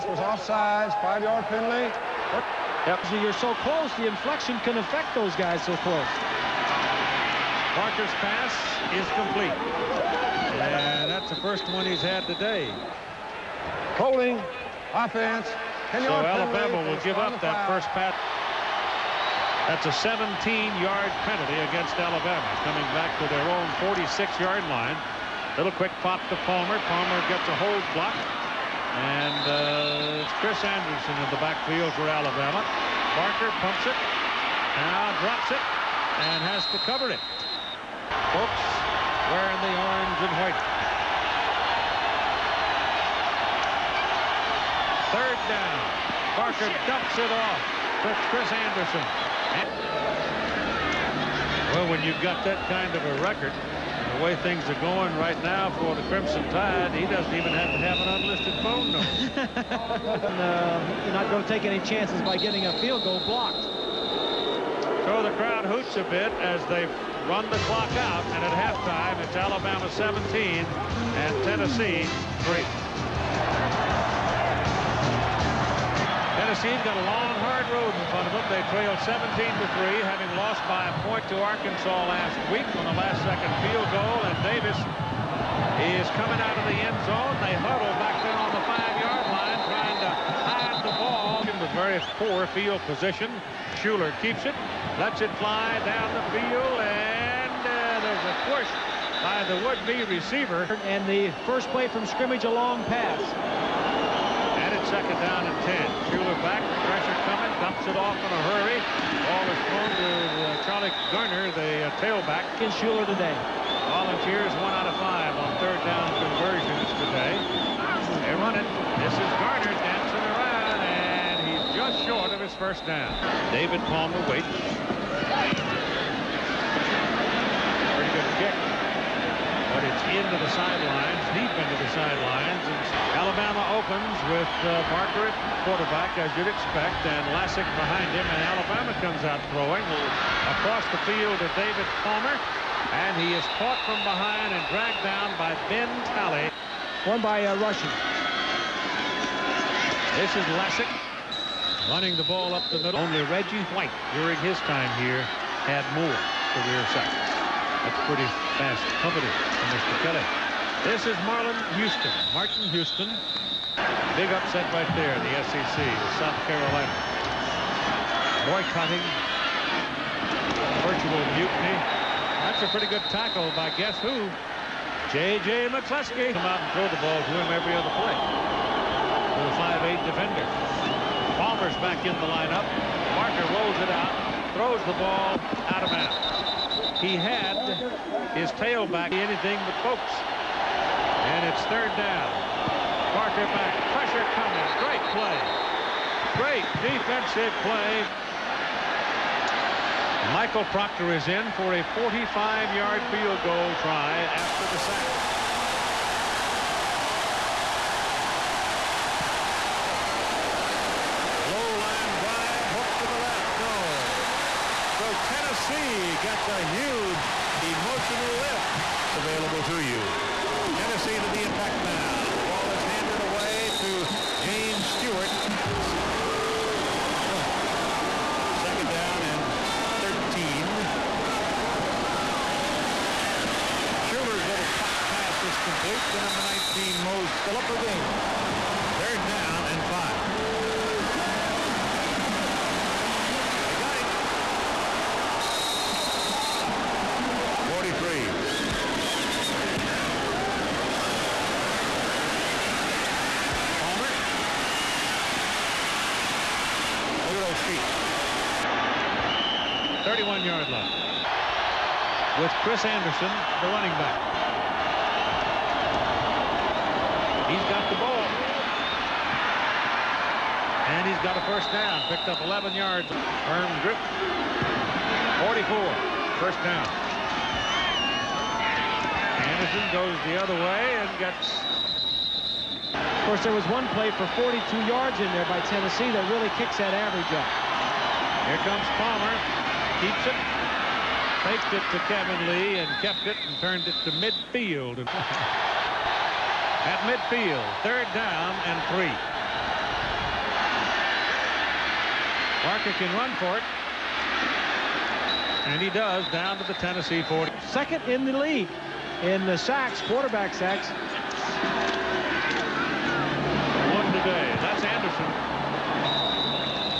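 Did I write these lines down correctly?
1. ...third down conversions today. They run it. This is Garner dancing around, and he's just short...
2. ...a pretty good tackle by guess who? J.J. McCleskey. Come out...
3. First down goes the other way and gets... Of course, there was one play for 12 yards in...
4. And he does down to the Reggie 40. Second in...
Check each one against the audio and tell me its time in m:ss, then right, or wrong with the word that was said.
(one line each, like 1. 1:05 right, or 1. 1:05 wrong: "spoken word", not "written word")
1. 1:55 right
2. 2:52 right
3. 4:36 wrong: "42", not "12"
4. 5:05 wrong: "Tennessee", not "Reggie".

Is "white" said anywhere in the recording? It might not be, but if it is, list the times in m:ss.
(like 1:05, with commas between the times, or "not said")
0:40, 2:33.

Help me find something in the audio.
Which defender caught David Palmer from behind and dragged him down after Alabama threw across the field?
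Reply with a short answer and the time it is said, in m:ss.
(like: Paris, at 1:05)
Ben Talley, at 2:25.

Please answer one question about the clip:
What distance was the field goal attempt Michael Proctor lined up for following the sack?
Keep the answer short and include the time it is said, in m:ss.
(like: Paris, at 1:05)
45 yards, at 3:21.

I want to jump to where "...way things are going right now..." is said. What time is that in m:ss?
0:54.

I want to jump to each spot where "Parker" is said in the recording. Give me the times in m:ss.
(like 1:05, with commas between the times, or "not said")
0:07, 3:03, 3:13, 5:02.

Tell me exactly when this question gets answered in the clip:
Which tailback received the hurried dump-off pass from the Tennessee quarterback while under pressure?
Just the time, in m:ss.
1:50.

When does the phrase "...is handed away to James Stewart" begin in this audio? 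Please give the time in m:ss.
3:42.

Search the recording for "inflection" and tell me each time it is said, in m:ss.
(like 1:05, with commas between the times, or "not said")
0:04.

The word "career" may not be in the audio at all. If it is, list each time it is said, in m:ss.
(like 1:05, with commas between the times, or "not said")
2:36.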